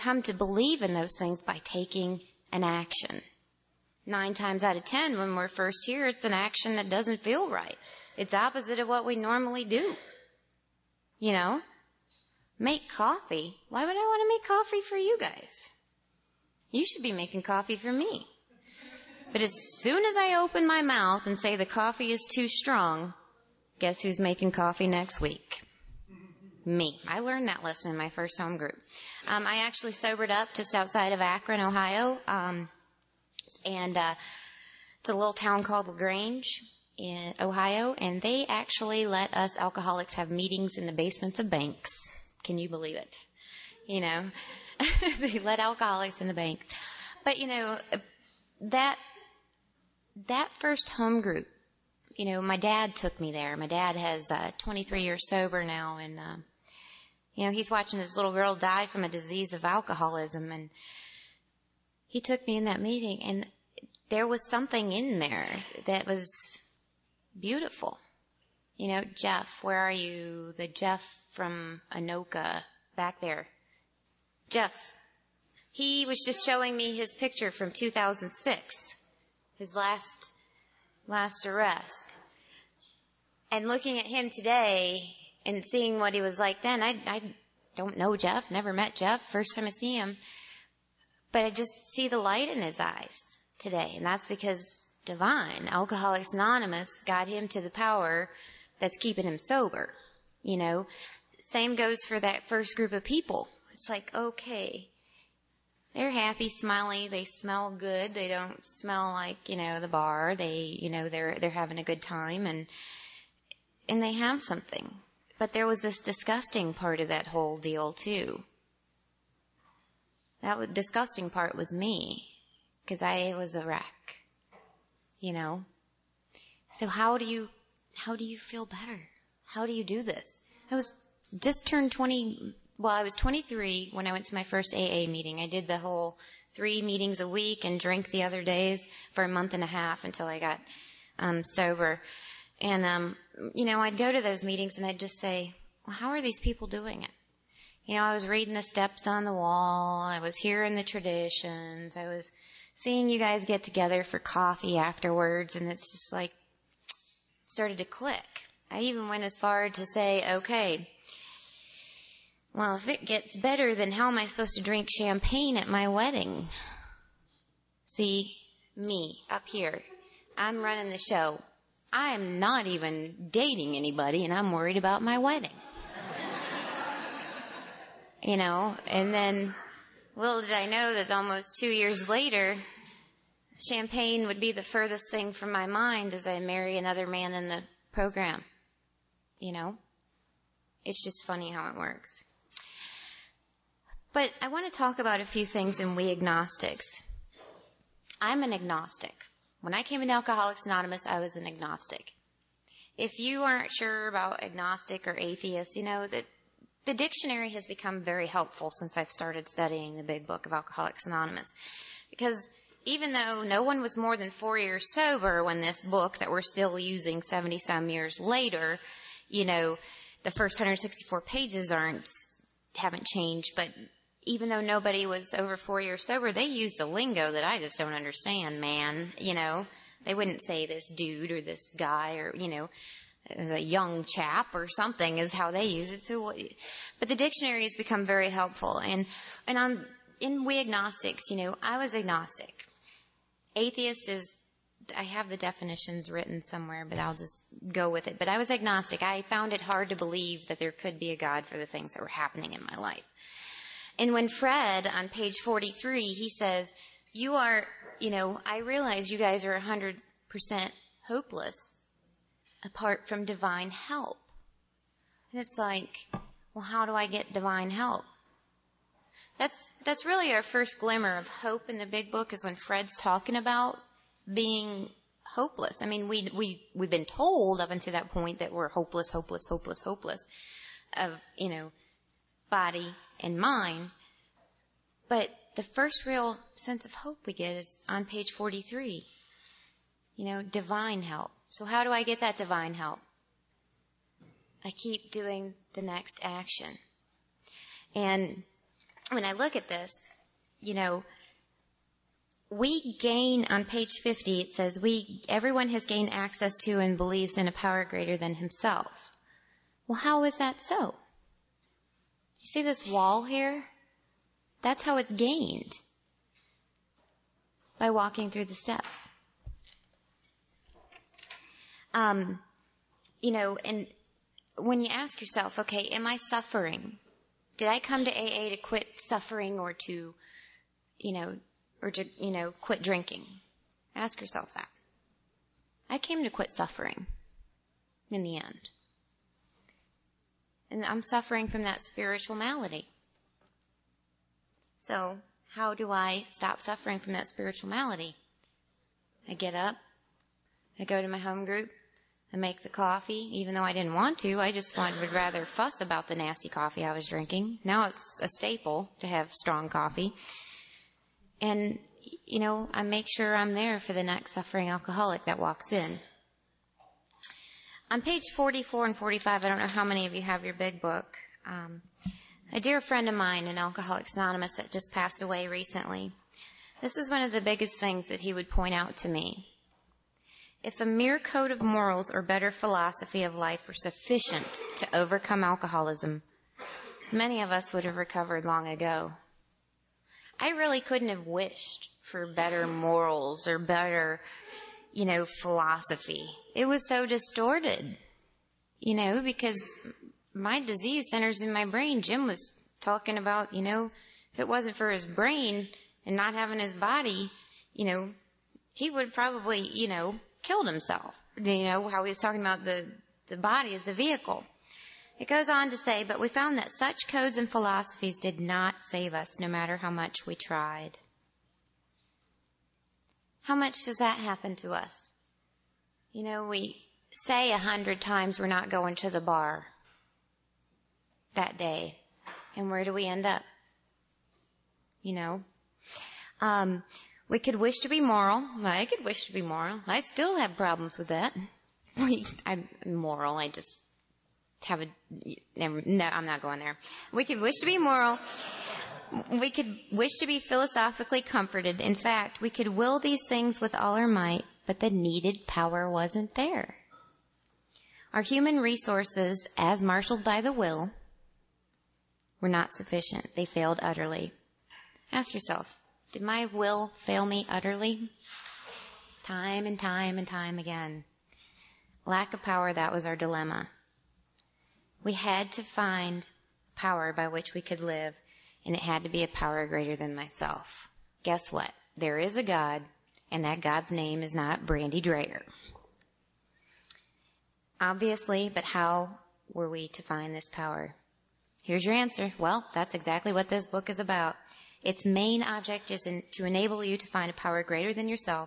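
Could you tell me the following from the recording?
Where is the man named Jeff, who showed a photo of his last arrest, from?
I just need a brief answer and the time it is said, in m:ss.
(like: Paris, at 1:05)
Anoka, at 1:11.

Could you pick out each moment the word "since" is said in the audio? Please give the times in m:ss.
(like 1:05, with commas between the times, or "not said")
3:28.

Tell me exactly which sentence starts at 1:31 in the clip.
But I just see the light in his eyes today.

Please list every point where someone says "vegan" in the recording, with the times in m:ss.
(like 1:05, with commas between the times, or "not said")
not said.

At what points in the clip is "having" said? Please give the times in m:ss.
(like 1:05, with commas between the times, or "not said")
1:51, 6:46.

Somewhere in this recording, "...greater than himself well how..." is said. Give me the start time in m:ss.
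5:07.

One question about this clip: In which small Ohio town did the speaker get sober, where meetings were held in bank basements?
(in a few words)
Lagrange.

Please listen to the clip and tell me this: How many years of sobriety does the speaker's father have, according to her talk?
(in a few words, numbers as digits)
23 years.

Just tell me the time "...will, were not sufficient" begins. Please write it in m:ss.
7:40.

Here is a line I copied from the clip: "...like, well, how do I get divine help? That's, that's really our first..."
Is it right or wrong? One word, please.
right.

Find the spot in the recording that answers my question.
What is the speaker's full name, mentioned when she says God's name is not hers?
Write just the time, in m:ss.
8:04.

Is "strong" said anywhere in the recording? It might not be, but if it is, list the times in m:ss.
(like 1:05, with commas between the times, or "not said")
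0:22, 5:59.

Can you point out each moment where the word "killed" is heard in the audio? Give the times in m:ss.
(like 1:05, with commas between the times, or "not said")
6:50.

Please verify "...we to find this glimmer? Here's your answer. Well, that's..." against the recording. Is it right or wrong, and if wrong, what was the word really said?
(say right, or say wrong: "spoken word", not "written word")
wrong: "power", not "glimmer".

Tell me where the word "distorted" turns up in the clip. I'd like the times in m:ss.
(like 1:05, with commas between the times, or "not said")
6:37.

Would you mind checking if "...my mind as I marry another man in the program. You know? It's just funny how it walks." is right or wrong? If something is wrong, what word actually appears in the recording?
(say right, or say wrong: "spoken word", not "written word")
wrong: "works", not "walks".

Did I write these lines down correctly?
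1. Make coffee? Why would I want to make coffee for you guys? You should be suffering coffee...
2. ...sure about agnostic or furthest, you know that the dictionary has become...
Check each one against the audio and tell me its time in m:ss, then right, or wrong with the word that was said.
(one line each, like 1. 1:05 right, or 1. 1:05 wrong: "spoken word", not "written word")
1. 0:12 wrong: "making", not "suffering"
2. 3:23 wrong: "atheist", not "furthest".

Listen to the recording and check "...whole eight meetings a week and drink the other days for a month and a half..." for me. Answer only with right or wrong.
wrong.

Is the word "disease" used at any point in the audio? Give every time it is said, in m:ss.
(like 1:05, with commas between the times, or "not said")
0:59, 6:40.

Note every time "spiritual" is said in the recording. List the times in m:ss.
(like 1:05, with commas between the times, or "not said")
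5:41, 5:47.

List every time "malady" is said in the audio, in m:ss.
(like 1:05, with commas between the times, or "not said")
5:42, 5:47.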